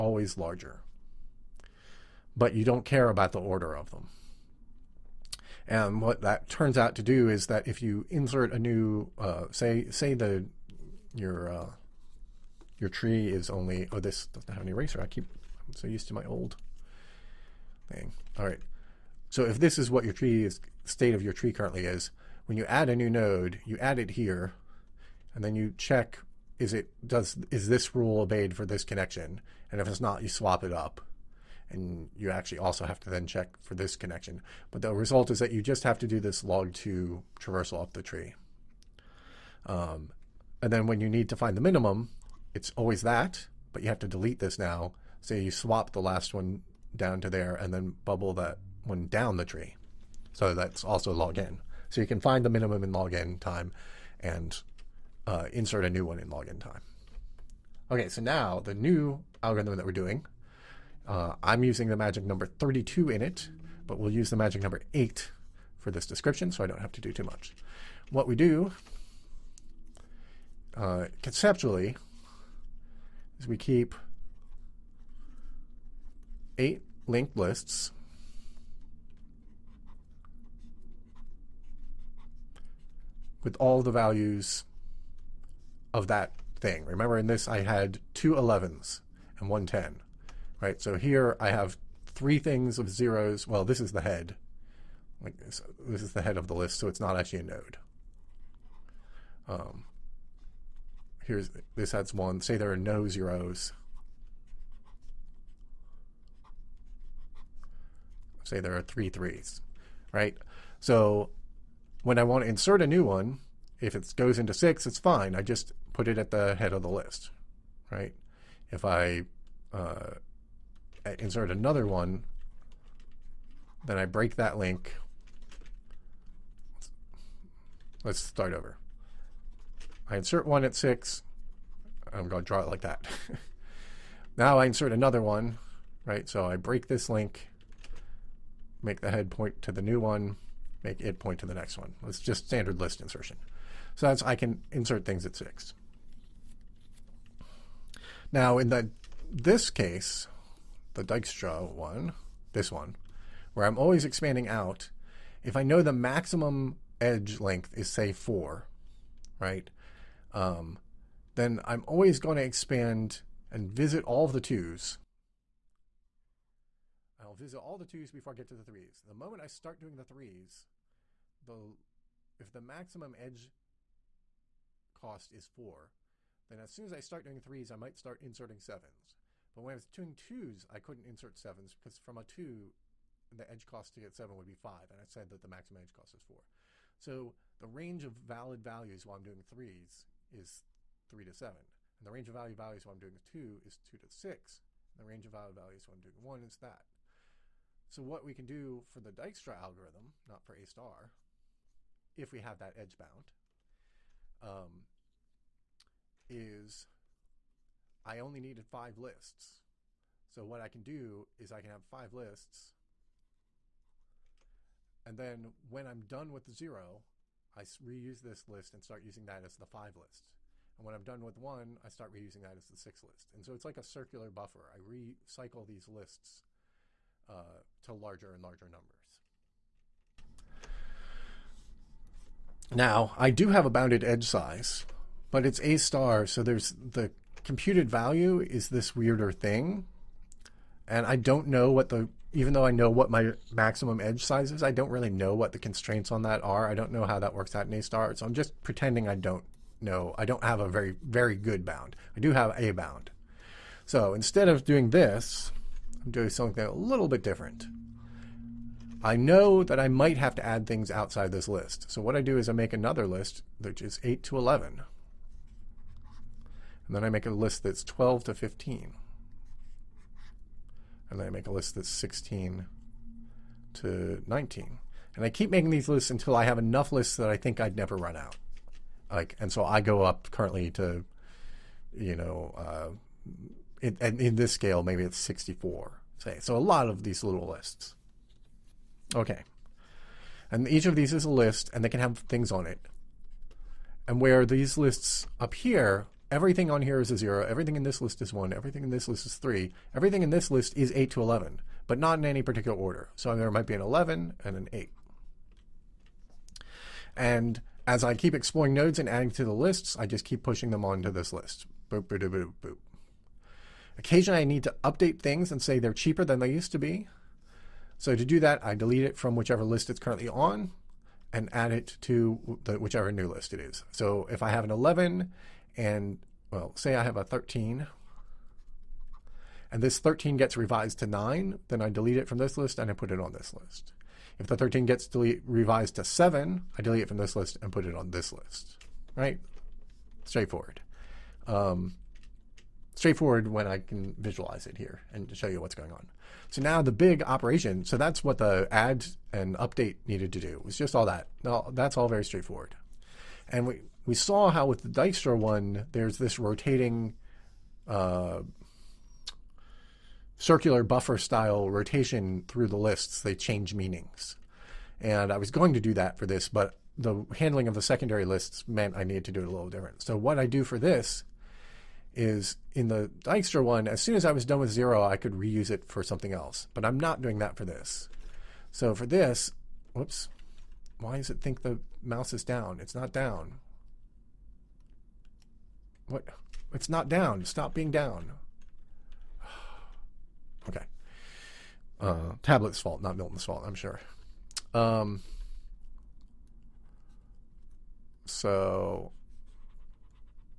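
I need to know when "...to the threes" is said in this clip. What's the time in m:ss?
2:48.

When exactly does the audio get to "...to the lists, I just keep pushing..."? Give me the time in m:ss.
5:09.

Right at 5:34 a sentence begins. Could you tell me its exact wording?
If the 13 gets delete, revised to 7, I delete it from this list and put it on this list, right?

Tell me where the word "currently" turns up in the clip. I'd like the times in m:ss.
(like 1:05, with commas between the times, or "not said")
0:21, 4:40, 5:19.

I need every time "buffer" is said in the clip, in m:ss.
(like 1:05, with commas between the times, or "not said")
3:44, 6:00.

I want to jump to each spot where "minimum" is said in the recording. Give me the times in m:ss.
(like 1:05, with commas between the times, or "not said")
0:41, 0:52.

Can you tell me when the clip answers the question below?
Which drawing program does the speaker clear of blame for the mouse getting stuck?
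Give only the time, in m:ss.
6:33.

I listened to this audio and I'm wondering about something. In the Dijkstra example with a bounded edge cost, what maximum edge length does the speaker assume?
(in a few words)
4.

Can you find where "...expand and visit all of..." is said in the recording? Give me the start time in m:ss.
2:42.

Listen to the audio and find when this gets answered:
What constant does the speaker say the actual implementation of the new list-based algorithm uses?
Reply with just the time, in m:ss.
1:01.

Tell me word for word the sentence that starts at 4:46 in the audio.
So a lot of these little lists.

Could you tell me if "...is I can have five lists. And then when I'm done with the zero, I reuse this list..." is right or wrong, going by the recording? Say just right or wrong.
right.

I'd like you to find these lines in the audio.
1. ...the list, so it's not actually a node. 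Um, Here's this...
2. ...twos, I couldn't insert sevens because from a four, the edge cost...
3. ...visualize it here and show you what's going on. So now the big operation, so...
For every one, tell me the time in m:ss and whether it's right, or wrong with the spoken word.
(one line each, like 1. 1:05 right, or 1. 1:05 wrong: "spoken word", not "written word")
1. 1:36 right
2. 3:00 wrong: "two", not "four"
3. 5:44 right.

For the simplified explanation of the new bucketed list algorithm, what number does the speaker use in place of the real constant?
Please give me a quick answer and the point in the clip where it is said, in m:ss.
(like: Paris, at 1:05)
8, at 1:04.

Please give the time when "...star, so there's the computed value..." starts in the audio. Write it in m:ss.
3:55.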